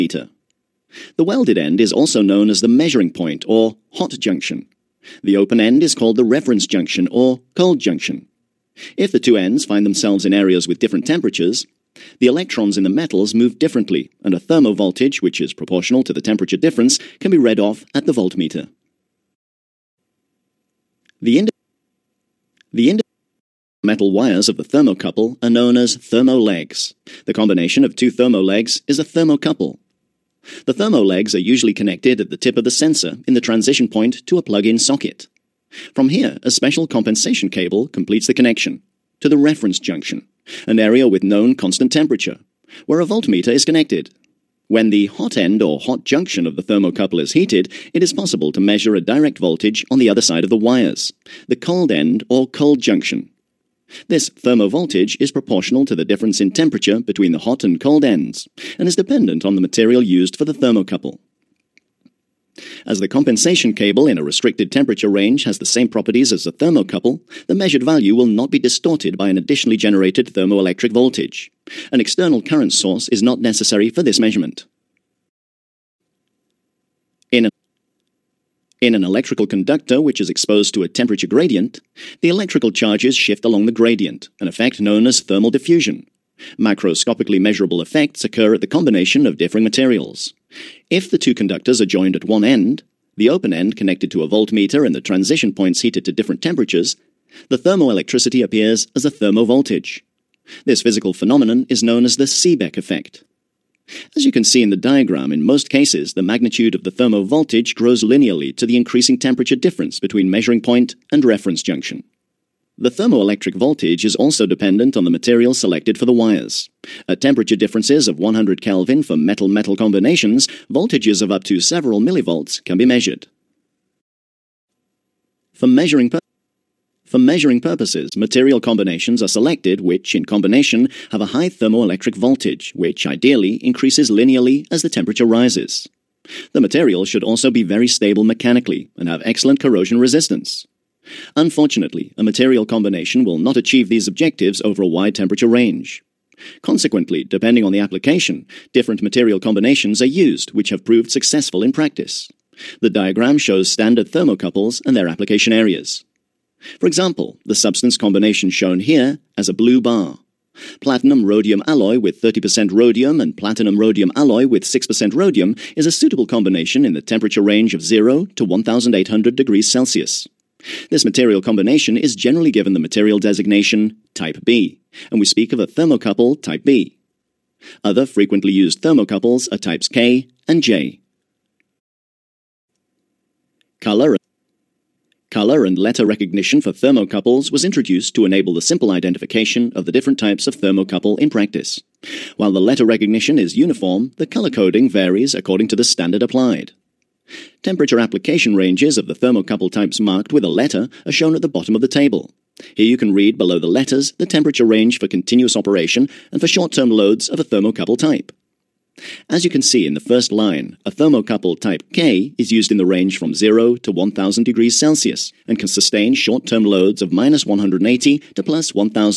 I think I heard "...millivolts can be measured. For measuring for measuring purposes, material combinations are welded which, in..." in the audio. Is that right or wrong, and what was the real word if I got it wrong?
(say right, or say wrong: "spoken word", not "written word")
wrong: "selected", not "welded".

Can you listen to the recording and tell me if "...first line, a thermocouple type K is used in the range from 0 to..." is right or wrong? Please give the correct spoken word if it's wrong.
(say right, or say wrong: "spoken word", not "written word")
right.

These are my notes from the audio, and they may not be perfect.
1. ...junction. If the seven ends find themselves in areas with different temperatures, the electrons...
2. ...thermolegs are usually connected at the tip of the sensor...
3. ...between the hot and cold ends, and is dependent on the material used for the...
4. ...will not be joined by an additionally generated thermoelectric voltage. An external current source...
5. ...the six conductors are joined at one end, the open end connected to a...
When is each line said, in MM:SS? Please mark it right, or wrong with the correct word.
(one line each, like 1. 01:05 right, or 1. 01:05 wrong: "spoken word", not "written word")
1. 00:07 wrong: "two", not "seven"
2. 00:30 right
3. 00:56 right
4. 01:08 wrong: "distorted", not "joined"
5. 01:31 wrong: "two", not "six".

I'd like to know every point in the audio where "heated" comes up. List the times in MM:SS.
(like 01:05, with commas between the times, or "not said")
00:47, 01:35.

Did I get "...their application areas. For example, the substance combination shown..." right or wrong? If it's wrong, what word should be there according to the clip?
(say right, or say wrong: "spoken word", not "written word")
right.